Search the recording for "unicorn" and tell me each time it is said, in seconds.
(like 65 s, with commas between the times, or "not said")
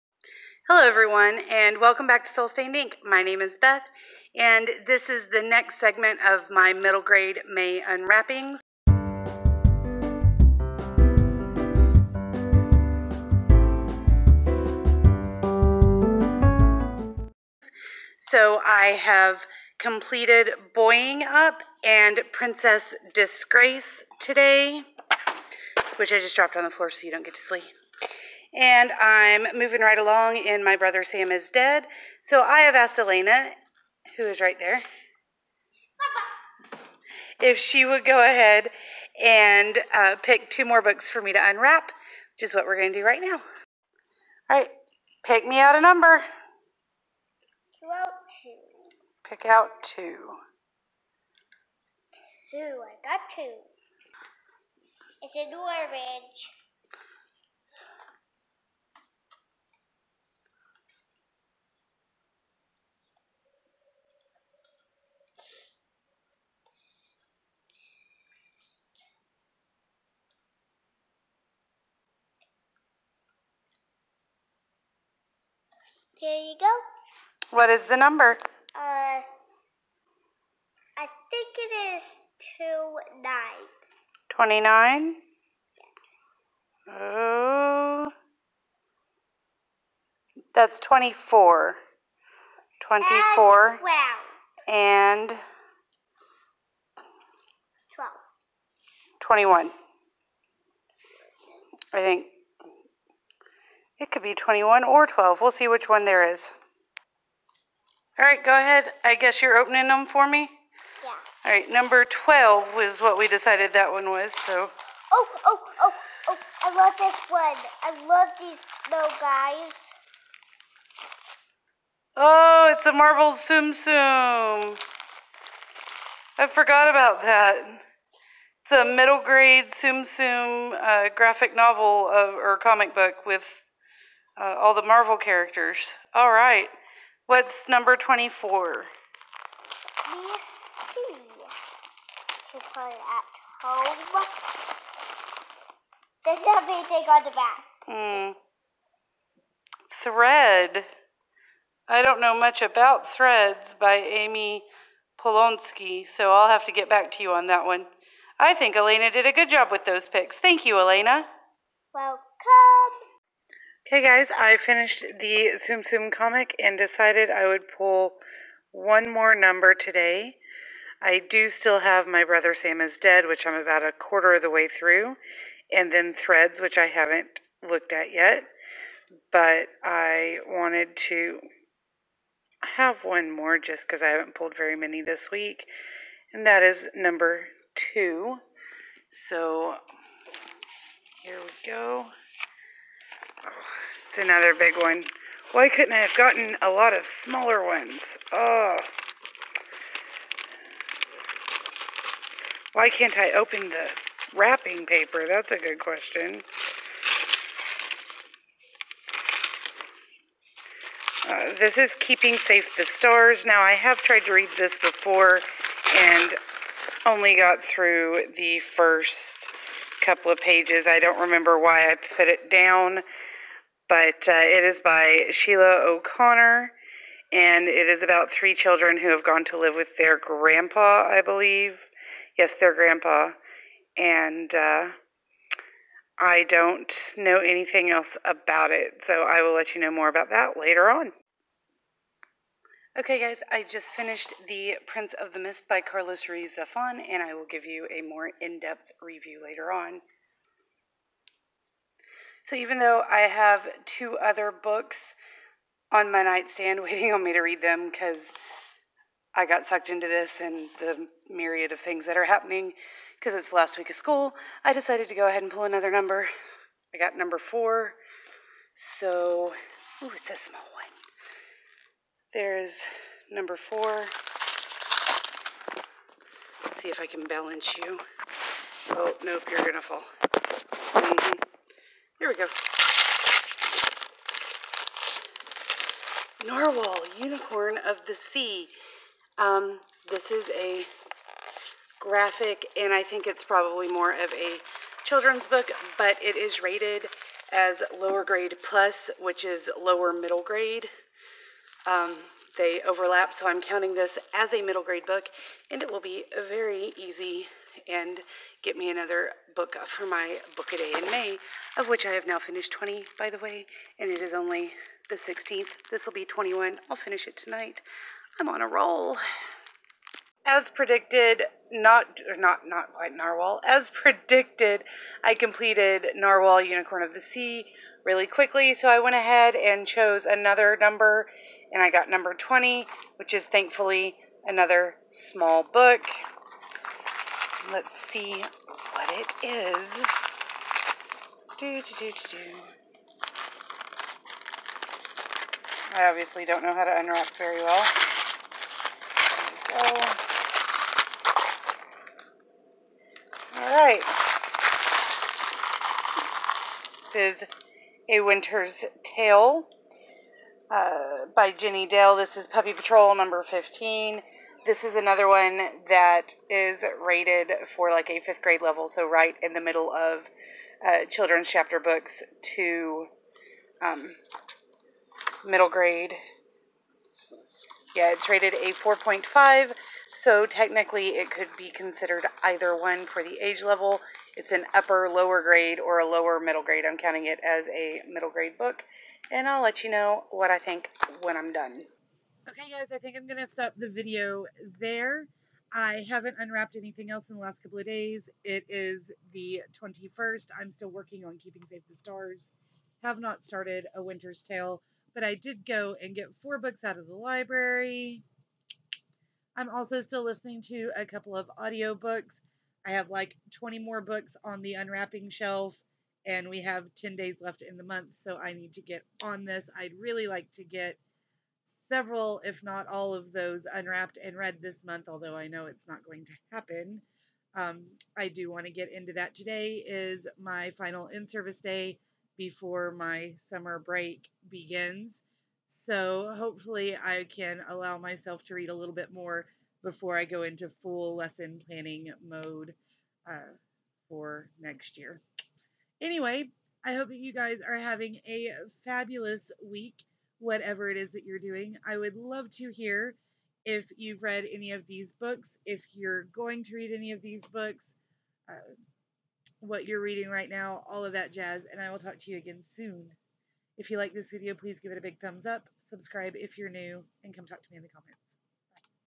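287 s, 326 s.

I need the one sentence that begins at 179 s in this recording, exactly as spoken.
But I wanted to have one more just because I haven't pulled very many this week, and that is number two.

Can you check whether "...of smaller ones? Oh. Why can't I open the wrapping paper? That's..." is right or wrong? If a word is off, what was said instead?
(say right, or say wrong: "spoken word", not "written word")
right.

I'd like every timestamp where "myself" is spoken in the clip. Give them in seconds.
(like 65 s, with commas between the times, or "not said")
437 s.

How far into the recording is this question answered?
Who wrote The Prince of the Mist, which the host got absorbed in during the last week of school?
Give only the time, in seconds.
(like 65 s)
245 s.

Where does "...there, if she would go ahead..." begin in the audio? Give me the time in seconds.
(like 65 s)
34 s.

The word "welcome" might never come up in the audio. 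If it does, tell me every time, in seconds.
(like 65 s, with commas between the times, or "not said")
1 s, 161 s.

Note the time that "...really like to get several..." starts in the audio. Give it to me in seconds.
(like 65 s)
419 s.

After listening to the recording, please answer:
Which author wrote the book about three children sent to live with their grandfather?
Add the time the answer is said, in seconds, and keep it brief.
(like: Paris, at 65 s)
Sheila O'Connor, at 225 s.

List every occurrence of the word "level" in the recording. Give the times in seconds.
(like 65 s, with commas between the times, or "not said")
368 s, 383 s.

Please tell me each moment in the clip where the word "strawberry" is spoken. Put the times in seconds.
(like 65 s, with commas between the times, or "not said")
not said.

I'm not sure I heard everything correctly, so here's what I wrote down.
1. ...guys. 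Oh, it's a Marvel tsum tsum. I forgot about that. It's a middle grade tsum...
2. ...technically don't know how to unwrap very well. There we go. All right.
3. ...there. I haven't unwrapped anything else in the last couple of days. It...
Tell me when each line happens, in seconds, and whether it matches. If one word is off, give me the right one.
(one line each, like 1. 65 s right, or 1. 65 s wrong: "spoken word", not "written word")
1. 119 s right
2. 346 s wrong: "obviously", not "technically"
3. 394 s right.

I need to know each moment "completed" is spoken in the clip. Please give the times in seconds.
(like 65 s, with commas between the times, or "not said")
19 s, 325 s.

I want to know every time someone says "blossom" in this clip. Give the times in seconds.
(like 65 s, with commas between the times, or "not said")
not said.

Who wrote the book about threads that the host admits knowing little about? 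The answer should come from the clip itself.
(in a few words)
Ami Polonsky.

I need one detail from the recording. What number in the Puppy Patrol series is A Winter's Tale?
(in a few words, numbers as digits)
15.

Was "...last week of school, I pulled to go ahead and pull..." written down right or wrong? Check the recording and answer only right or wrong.
wrong.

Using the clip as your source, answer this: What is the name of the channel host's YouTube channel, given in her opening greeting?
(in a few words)
Soul Stained Ink.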